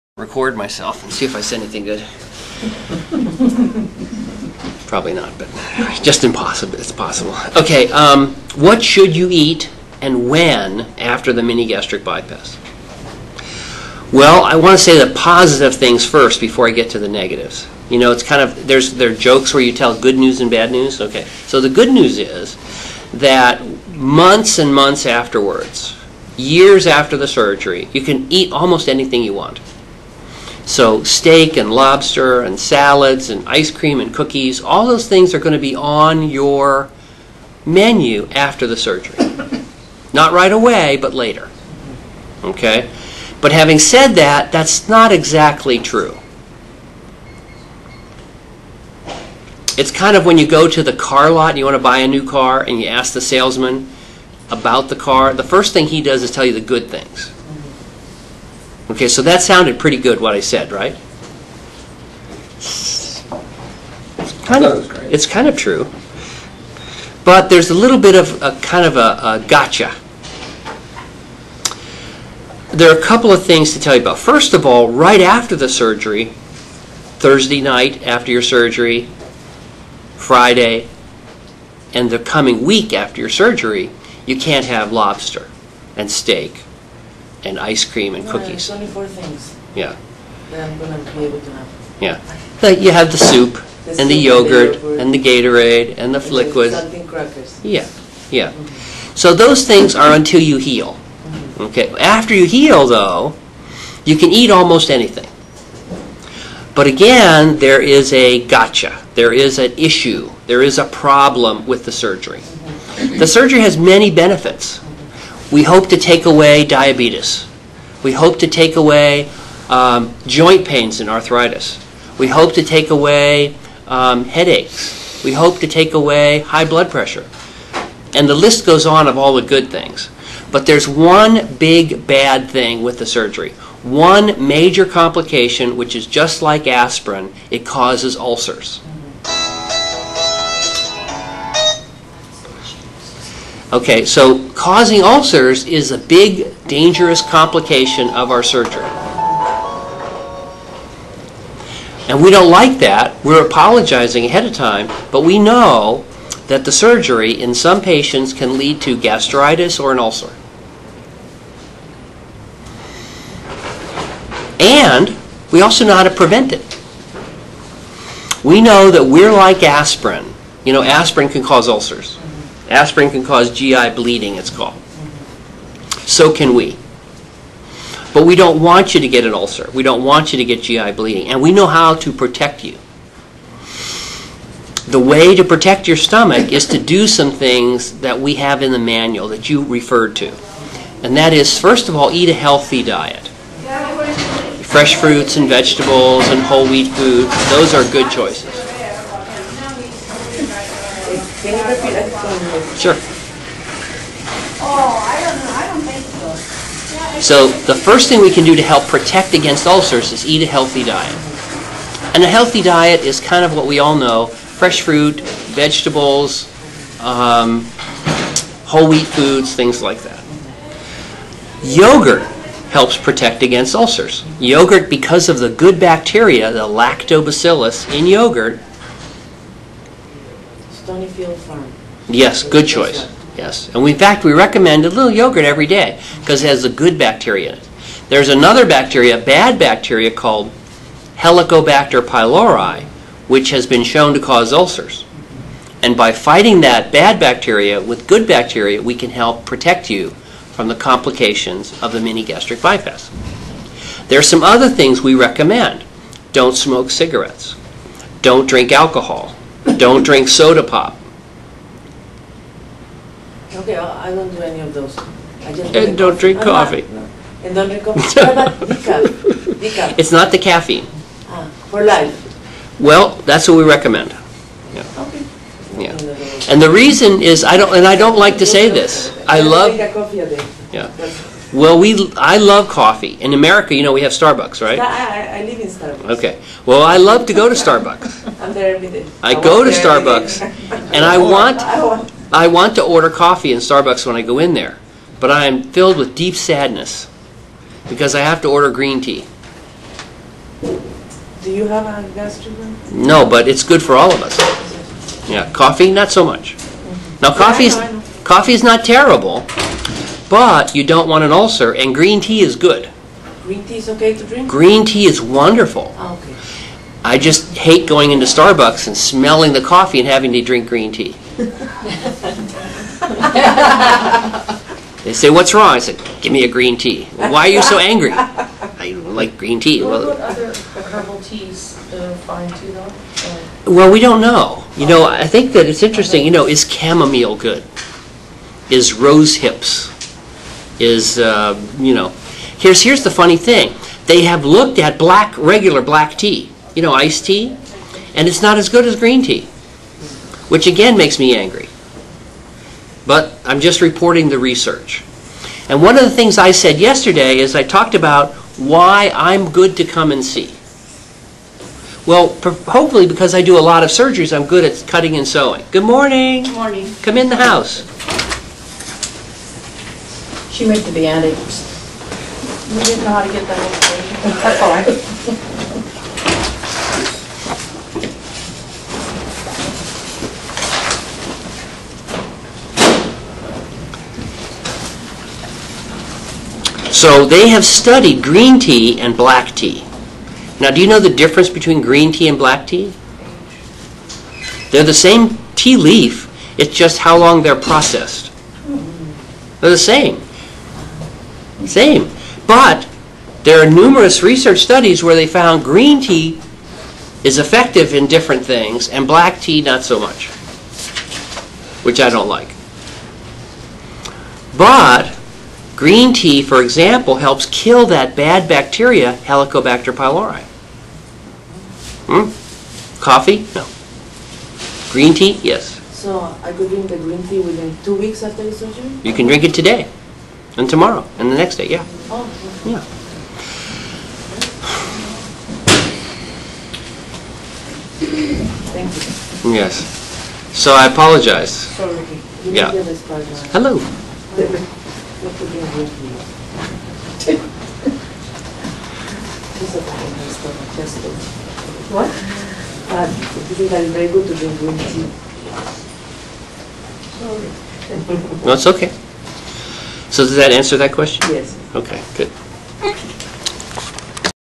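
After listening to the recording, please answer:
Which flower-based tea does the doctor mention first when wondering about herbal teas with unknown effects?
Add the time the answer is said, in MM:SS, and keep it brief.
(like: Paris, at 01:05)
chamomile, at 05:36.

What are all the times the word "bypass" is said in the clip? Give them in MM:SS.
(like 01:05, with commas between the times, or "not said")
00:12, 04:12.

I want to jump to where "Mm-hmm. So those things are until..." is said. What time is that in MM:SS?
01:38.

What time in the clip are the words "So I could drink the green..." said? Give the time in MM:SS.
07:05.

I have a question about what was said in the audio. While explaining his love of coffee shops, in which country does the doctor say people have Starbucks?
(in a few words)
America.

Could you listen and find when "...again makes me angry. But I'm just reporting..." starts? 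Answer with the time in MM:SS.
05:50.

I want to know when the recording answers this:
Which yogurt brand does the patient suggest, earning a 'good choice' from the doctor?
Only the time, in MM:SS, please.
03:50.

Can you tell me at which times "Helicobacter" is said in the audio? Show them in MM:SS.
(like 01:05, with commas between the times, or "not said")
04:01, 06:59.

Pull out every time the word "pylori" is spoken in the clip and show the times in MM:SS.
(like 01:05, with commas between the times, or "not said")
04:02, 06:59.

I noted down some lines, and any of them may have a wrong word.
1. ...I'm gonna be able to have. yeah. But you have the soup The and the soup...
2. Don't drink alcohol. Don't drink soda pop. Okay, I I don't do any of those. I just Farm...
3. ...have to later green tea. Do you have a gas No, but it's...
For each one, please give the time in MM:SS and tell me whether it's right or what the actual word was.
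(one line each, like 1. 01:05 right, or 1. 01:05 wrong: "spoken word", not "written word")
1. 01:30 right
2. 04:18 wrong: "And", not "Farm"
3. 04:58 wrong: "order", not "later".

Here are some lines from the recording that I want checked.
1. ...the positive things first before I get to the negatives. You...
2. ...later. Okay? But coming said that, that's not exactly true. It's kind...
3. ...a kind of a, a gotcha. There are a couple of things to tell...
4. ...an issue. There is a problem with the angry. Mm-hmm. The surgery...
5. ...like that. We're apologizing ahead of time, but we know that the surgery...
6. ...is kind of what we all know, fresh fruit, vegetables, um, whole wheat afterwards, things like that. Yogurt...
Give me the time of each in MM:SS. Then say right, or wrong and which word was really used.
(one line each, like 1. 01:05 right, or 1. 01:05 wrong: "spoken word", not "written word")
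1. 00:15 right
2. 00:41 wrong: "having", not "coming"
3. 01:08 right
4. 01:49 wrong: "surgery", not "angry"
5. 02:32 right
6. 03:33 wrong: "foods", not "afterwards".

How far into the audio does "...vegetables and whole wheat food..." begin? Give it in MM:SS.
03:15.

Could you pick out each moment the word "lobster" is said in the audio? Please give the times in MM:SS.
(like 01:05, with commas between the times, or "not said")
00:31, 01:24.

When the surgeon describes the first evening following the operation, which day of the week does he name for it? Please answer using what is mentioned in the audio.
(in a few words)
Thursday.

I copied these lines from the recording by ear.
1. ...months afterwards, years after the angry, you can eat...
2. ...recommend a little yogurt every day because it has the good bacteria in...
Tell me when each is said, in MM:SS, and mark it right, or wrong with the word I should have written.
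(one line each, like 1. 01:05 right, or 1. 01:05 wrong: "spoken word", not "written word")
1. 00:24 wrong: "surgery", not "angry"
2. 03:54 right.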